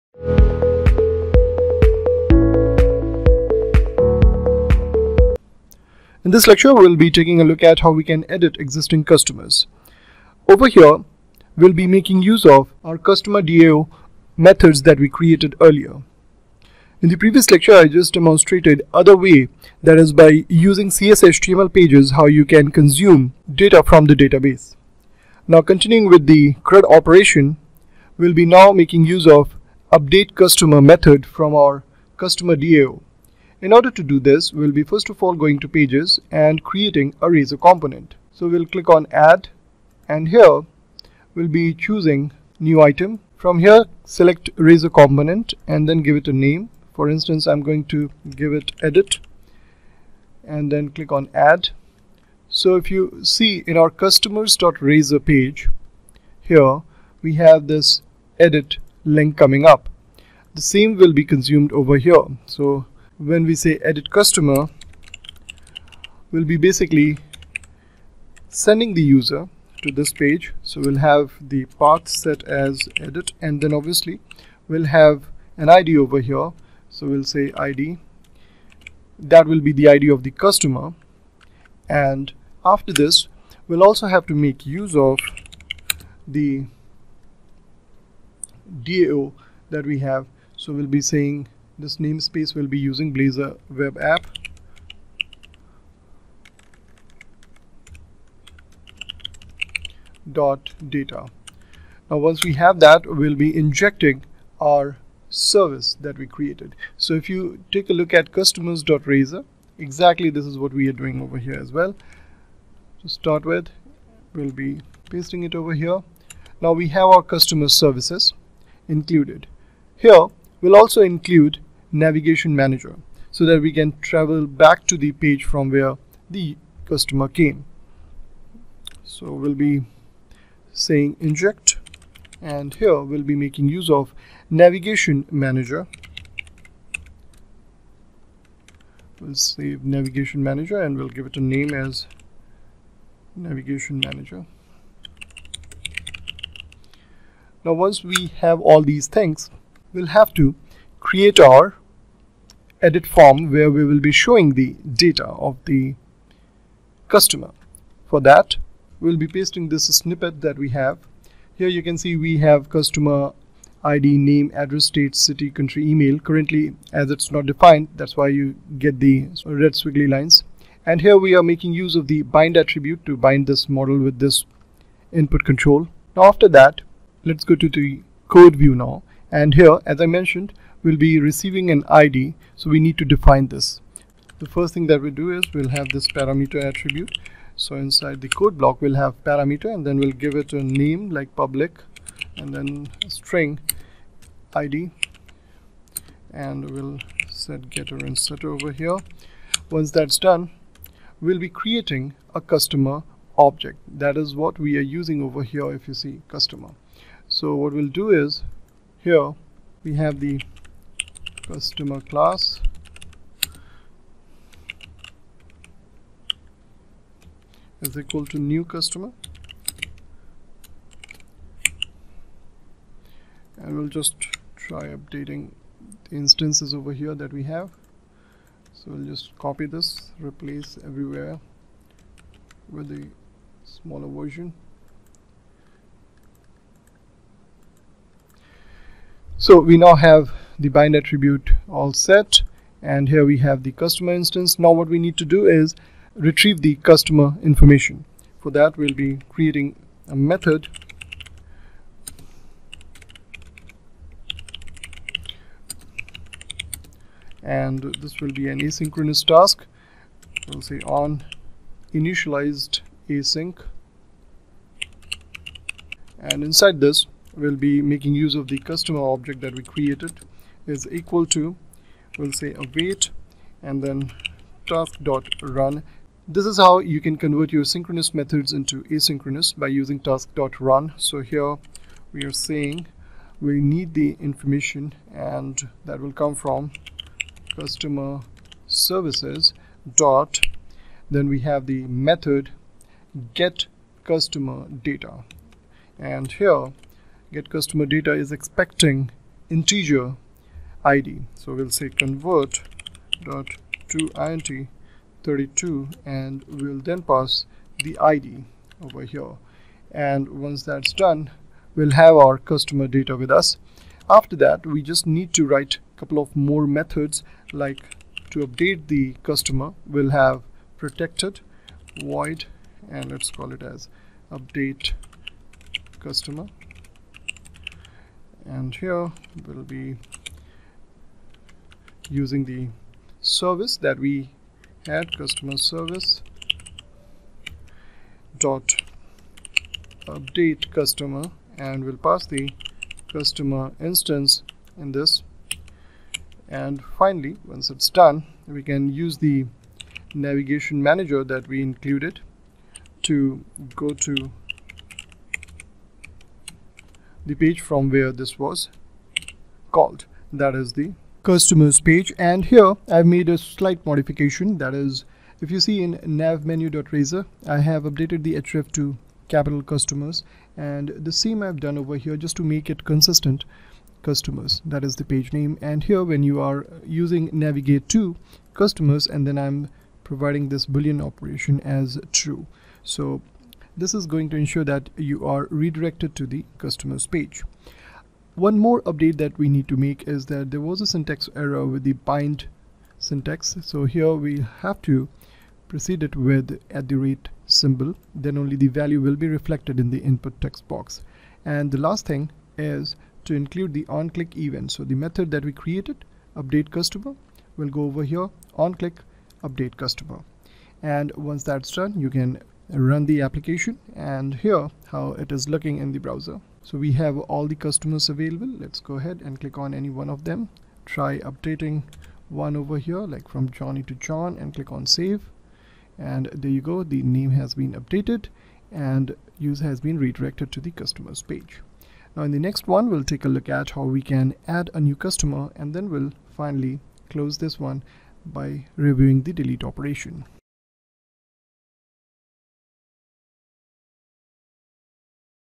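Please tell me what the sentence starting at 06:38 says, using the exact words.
Then only the value will be reflected in the input text box.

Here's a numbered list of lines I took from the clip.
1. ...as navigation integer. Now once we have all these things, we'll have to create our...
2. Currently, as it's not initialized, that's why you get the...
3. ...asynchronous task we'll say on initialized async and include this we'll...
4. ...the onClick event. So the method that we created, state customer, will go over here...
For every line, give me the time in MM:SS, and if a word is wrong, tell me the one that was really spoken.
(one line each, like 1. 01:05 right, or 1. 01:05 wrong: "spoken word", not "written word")
1. 02:21 wrong: "manager", not "integer"
2. 02:46 wrong: "defined", not "initialized"
3. 04:18 wrong: "inside", not "include"
4. 06:43 wrong: "update", not "state".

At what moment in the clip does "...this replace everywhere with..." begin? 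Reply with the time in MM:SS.
03:49.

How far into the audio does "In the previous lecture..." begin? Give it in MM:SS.
00:17.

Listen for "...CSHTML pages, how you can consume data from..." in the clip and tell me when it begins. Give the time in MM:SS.
00:20.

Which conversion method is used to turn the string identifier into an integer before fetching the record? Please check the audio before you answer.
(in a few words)
Convert.ToInt32.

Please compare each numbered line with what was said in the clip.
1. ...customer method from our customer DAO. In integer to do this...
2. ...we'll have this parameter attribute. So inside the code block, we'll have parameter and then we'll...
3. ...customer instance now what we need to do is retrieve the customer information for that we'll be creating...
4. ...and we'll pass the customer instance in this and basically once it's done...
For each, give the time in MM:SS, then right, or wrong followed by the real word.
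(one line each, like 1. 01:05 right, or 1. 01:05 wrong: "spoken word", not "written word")
1. 00:30 wrong: "order", not "integer"
2. 03:05 right
3. 04:03 right
4. 05:41 wrong: "finally", not "basically".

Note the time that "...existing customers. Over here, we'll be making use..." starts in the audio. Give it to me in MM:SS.
00:08.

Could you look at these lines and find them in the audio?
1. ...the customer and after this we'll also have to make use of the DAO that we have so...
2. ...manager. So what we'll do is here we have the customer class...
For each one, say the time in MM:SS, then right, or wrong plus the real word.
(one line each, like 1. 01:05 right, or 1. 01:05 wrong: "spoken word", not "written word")
1. 01:20 right
2. 03:26 wrong: "customer", not "manager".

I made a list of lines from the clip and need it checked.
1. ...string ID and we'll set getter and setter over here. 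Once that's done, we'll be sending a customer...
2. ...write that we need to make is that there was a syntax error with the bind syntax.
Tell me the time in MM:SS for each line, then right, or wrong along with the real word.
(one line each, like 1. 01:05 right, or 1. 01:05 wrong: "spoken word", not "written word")
1. 03:13 wrong: "creating", not "sending"
2. 06:28 wrong: "update", not "write".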